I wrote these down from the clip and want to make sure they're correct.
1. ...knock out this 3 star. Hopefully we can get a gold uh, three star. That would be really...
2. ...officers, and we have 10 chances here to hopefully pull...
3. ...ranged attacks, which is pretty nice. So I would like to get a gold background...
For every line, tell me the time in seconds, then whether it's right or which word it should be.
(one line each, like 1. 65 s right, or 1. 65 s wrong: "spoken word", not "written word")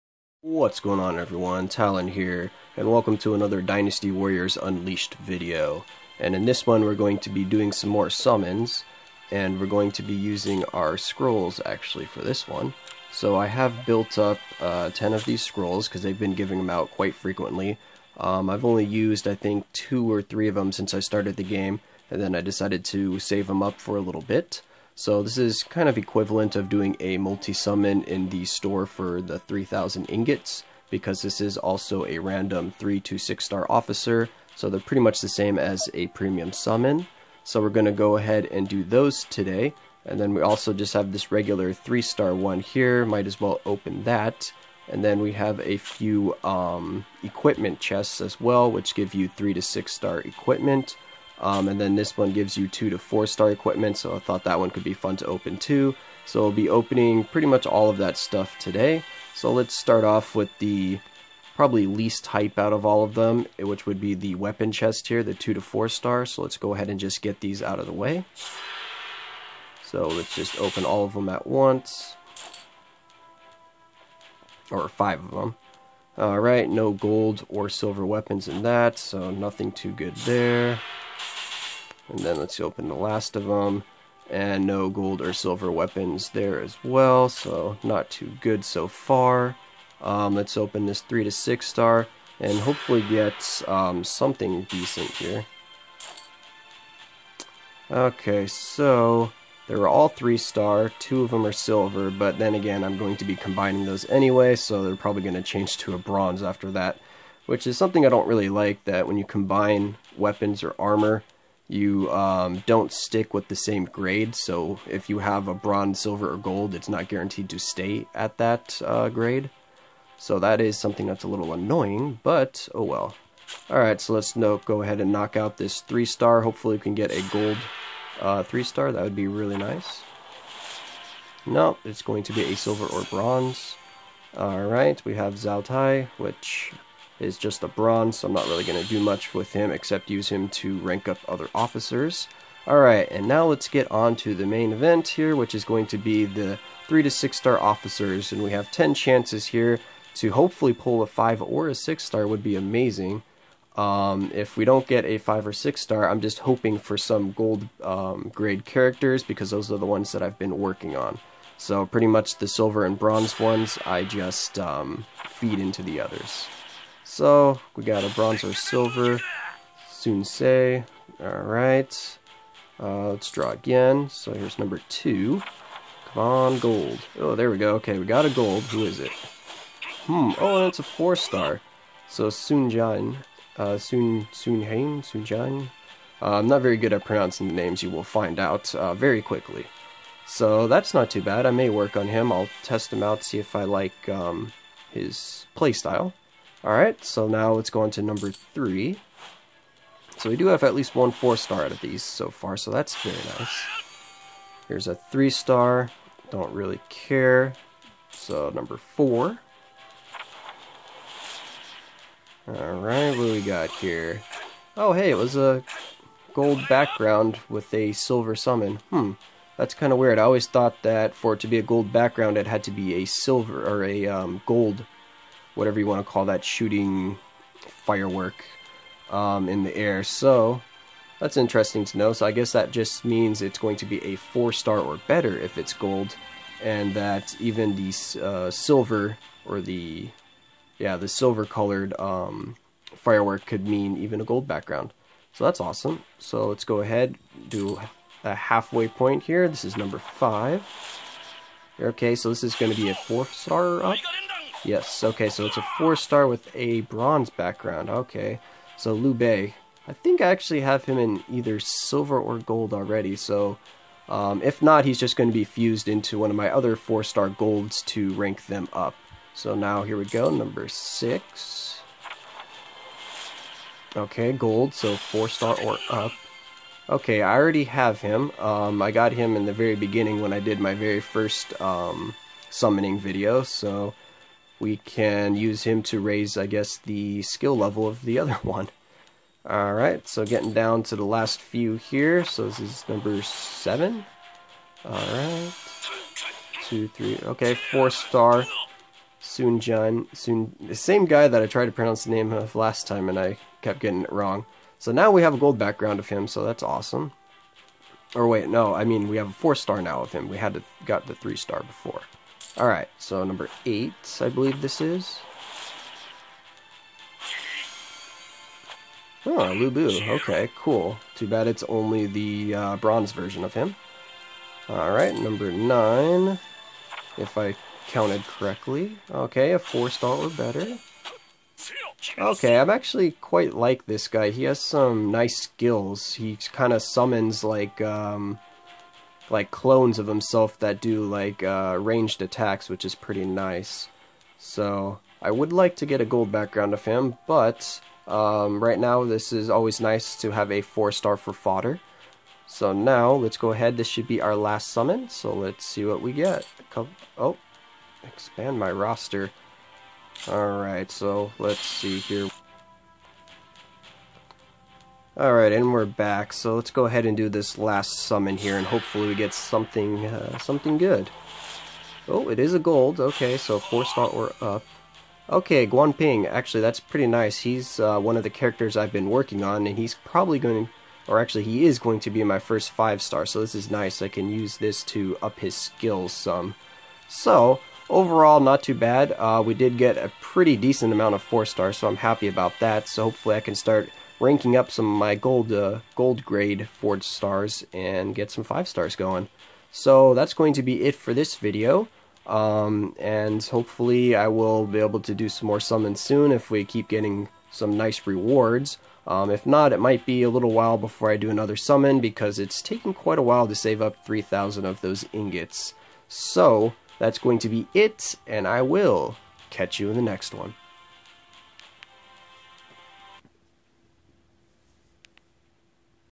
1. 125 s right
2. 147 s right
3. 341 s right.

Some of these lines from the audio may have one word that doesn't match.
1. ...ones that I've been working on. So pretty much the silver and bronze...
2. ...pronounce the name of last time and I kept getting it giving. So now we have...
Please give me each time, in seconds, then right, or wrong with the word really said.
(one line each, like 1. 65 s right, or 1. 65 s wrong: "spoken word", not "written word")
1. 159 s right
2. 301 s wrong: "wrong", not "giving".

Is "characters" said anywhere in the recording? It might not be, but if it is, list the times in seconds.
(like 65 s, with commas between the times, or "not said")
158 s, 378 s.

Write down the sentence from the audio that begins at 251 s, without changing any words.
Okay, so this is going to be a four star up.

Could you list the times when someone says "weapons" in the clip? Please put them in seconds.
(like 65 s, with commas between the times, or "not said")
64 s, 78 s, 85 s, 110 s.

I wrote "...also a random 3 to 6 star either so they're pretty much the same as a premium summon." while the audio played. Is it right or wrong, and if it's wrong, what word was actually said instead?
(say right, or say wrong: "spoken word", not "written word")
wrong: "officer", not "either".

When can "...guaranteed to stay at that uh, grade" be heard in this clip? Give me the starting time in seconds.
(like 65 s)
117 s.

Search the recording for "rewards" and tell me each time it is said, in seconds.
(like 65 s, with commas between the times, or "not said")
408 s.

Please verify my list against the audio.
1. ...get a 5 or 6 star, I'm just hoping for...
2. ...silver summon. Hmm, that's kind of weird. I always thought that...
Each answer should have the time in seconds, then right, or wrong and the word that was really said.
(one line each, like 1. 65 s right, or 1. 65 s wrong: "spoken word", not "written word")
1. 154 s right
2. 217 s right.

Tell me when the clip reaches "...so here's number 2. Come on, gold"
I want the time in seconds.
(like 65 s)
174 s.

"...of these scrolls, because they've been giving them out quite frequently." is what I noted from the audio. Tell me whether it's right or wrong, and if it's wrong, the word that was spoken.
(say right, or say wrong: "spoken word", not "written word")
right.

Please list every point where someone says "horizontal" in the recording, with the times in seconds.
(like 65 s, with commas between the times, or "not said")
not said.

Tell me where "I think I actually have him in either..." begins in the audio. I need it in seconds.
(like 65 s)
259 s.